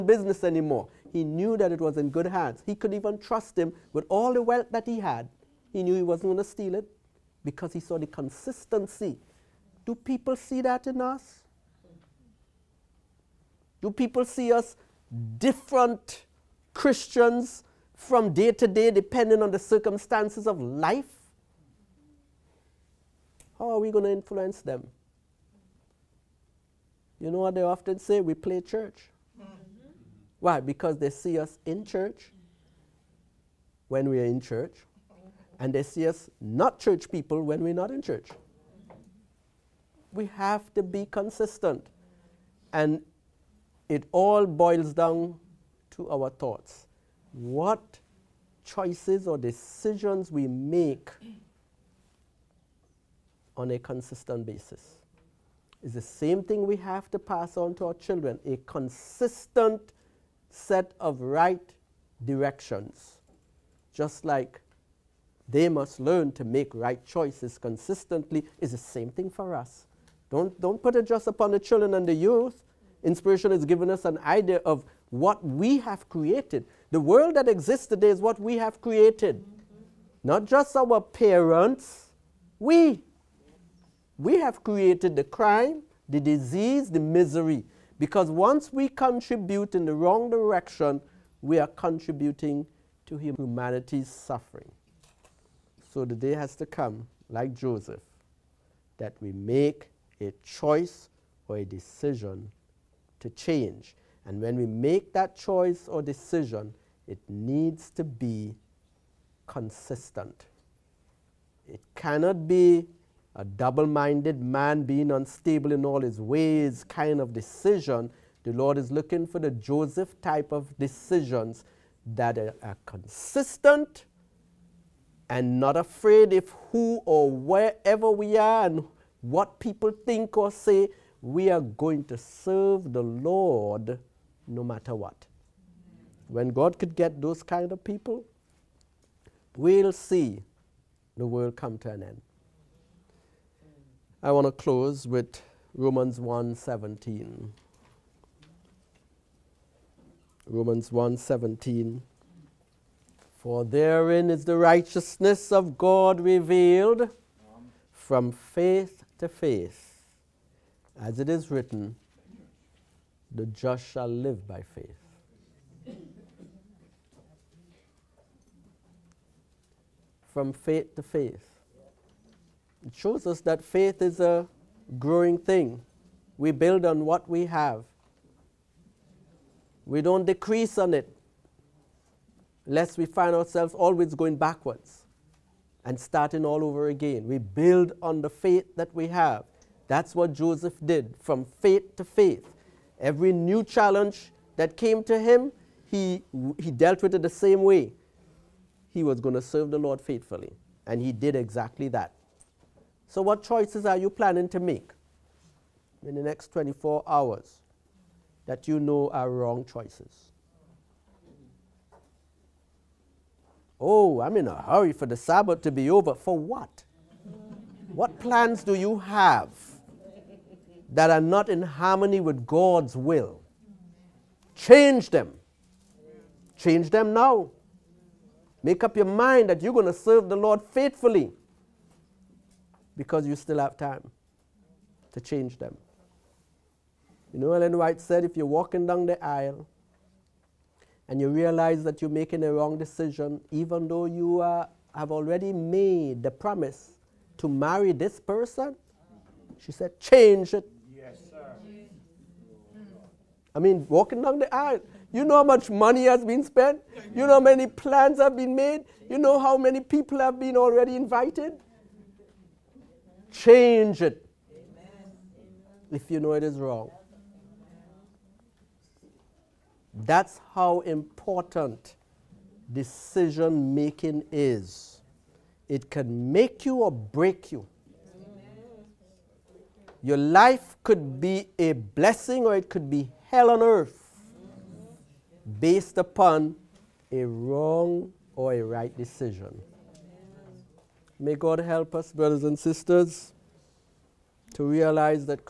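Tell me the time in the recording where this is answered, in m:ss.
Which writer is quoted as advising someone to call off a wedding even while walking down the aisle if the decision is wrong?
3:57.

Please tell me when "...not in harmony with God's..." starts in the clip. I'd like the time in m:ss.
3:41.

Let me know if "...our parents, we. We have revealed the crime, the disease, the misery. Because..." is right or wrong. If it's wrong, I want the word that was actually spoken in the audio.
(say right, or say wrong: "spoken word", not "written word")
wrong: "created", not "revealed".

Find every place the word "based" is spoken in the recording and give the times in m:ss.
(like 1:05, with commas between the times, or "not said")
4:45.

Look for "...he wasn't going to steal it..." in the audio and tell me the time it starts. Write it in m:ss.
0:05.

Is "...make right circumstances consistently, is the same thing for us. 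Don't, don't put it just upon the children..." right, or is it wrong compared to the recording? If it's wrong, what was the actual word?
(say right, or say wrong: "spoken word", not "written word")
wrong: "choices", not "circumstances".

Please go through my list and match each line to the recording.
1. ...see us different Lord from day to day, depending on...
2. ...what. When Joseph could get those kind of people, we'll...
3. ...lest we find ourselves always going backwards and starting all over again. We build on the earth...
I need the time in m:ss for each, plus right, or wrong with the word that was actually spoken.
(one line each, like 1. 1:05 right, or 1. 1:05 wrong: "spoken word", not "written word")
1. 0:14 wrong: "Christians", not "Lord"
2. 2:14 wrong: "God", not "Joseph"
3. 3:02 wrong: "faith", not "earth".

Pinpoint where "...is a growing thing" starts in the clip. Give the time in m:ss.
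2:54.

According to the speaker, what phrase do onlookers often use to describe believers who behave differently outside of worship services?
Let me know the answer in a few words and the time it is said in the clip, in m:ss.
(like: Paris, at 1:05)
Play church, at 0:28.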